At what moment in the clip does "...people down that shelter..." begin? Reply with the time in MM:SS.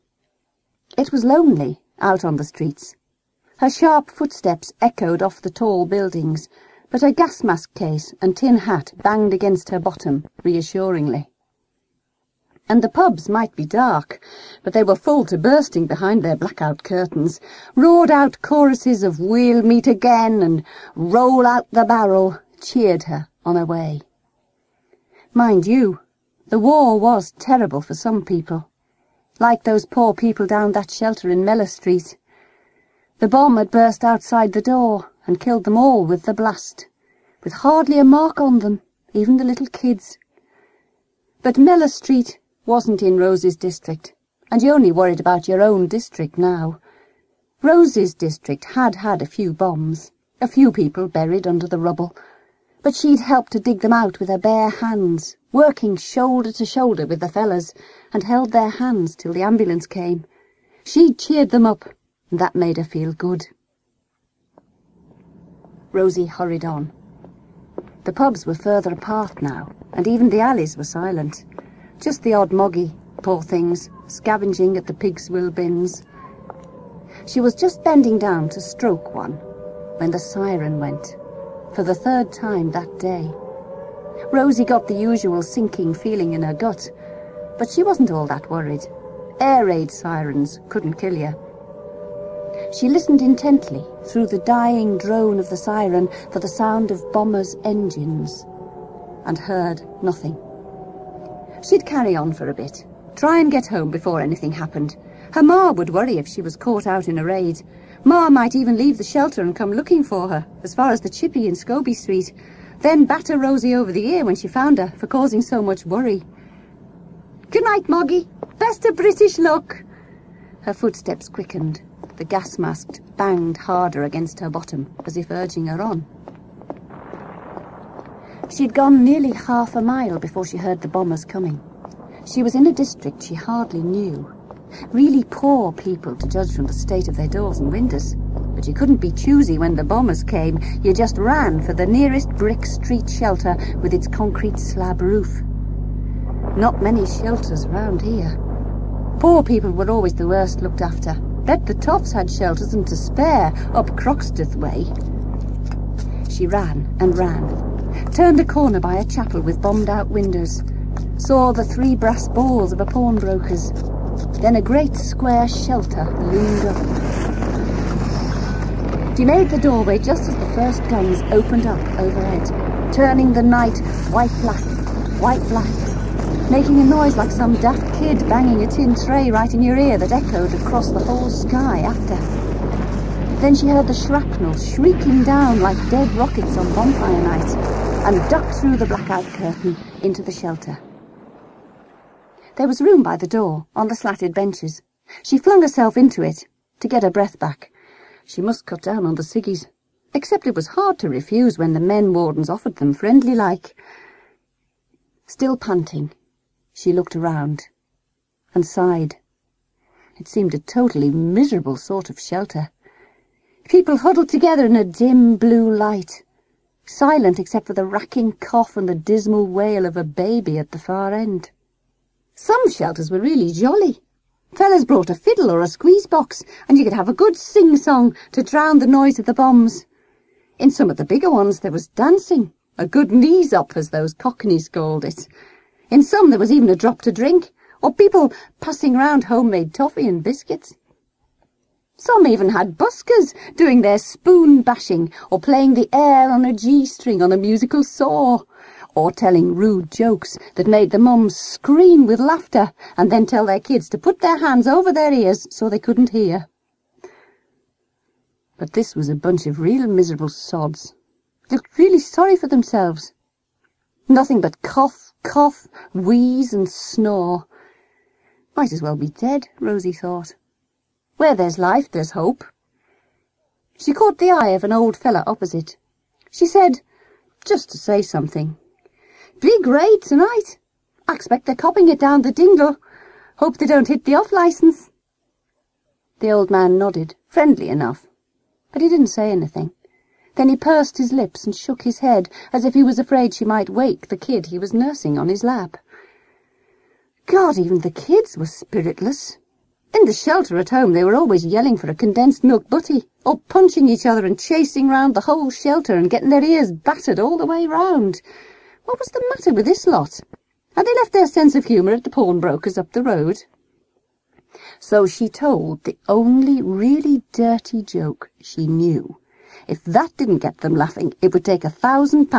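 00:30.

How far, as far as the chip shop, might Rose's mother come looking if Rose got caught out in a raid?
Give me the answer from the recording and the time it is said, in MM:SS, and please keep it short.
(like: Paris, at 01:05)
Scobie Street, at 01:51.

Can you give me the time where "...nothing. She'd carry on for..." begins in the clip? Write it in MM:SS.
01:40.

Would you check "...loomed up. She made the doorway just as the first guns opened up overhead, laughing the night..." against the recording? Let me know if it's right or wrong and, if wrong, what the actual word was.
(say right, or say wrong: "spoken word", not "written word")
wrong: "turning", not "laughing".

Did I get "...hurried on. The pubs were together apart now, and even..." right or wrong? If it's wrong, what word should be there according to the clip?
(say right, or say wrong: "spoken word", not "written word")
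wrong: "further", not "together".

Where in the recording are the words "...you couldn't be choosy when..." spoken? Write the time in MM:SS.
02:18.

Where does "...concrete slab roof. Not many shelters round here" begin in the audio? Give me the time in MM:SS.
02:24.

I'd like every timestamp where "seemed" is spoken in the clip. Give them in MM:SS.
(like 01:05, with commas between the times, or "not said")
03:30.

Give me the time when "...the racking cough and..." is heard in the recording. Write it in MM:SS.
03:37.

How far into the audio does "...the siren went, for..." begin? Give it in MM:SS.
01:20.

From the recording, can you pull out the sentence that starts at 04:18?
But this was a bunch of real miserable sods.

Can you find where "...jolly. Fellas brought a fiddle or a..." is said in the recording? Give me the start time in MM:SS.
03:43.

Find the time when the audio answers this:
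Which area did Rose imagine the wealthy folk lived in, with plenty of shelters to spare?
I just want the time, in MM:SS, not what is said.
02:33.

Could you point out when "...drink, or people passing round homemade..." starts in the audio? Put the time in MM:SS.
03:57.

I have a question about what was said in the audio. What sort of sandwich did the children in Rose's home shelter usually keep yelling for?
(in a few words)
Condensed milk butty.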